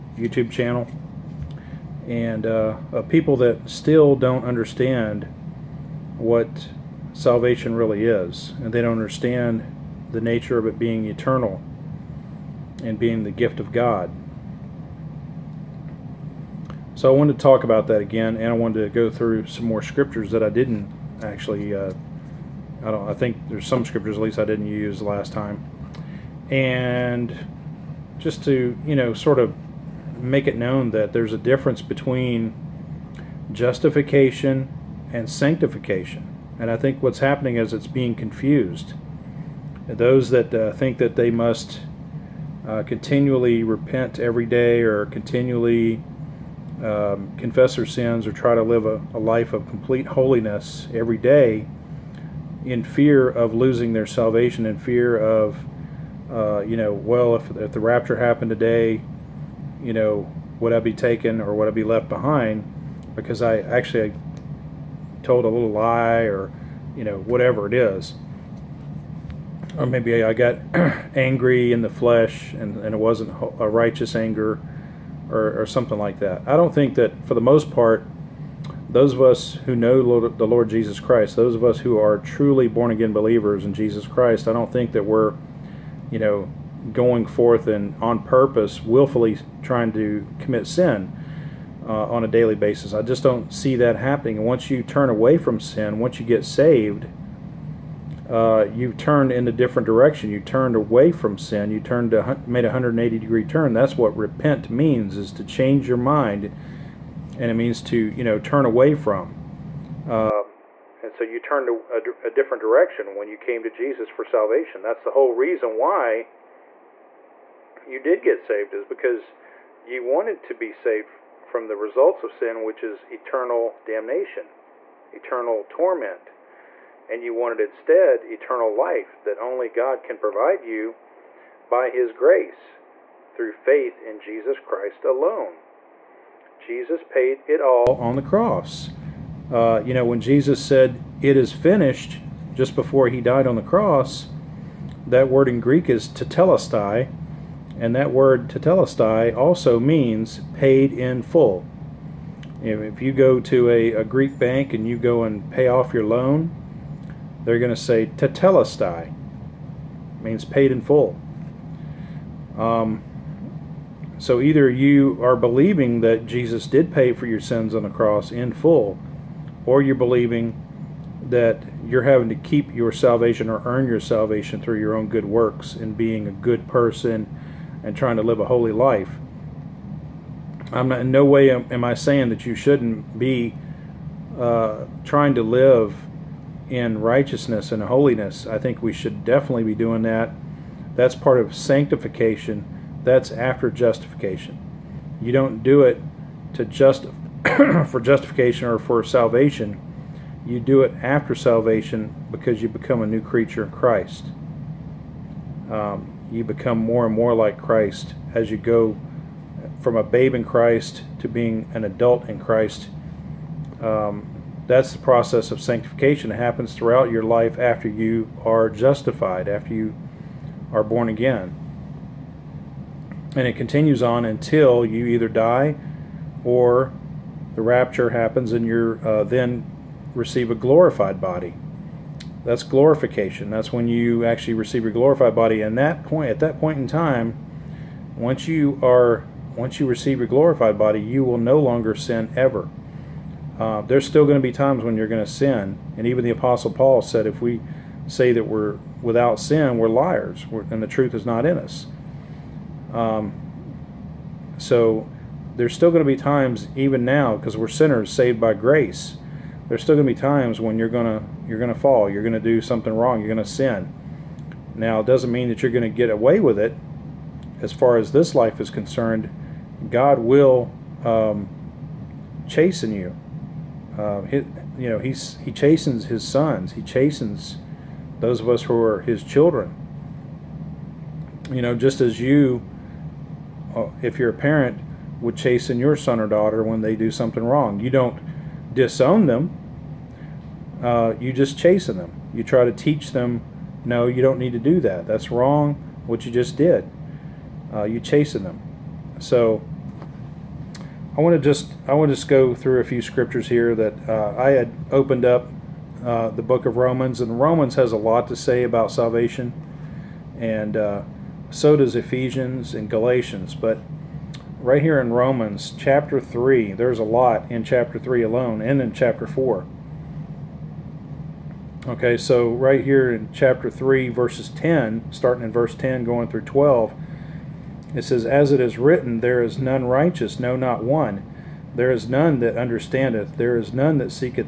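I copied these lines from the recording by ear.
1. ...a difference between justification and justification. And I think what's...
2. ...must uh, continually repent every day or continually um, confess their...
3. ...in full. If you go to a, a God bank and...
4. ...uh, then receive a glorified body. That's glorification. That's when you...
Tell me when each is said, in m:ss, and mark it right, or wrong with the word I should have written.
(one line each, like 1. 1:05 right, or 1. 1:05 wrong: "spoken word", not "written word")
1. 0:31 wrong: "sanctification", not "justification"
2. 0:41 right
3. 2:30 wrong: "Greek", not "God"
4. 3:49 right.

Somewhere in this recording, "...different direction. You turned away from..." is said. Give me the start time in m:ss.
1:39.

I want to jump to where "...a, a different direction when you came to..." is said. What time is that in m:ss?
1:51.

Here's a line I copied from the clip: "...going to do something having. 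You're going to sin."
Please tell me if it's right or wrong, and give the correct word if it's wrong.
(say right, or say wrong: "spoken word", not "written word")
wrong: "wrong", not "having".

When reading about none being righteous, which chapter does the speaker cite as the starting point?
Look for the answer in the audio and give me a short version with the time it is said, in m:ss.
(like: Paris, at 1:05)
chapter 3, at 5:23.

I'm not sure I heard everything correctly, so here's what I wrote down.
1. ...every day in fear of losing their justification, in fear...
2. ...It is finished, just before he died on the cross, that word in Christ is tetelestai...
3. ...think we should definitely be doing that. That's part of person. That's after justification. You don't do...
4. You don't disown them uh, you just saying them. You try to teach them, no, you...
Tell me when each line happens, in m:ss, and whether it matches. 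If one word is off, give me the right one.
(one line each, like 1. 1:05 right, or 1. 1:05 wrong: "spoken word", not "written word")
1. 0:50 wrong: "salvation", not "justification"
2. 2:21 wrong: "Greek", not "Christ"
3. 3:08 wrong: "sanctification", not "person"
4. 4:47 wrong: "chasing", not "saying".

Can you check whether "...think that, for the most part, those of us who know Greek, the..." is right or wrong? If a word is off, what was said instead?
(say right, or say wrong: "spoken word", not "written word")
wrong: "Lord", not "Greek".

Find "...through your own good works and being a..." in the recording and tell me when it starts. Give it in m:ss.
2:54.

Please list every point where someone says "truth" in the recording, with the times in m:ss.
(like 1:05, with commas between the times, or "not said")
4:10.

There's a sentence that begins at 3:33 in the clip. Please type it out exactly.
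Um, that's the process of sanctification.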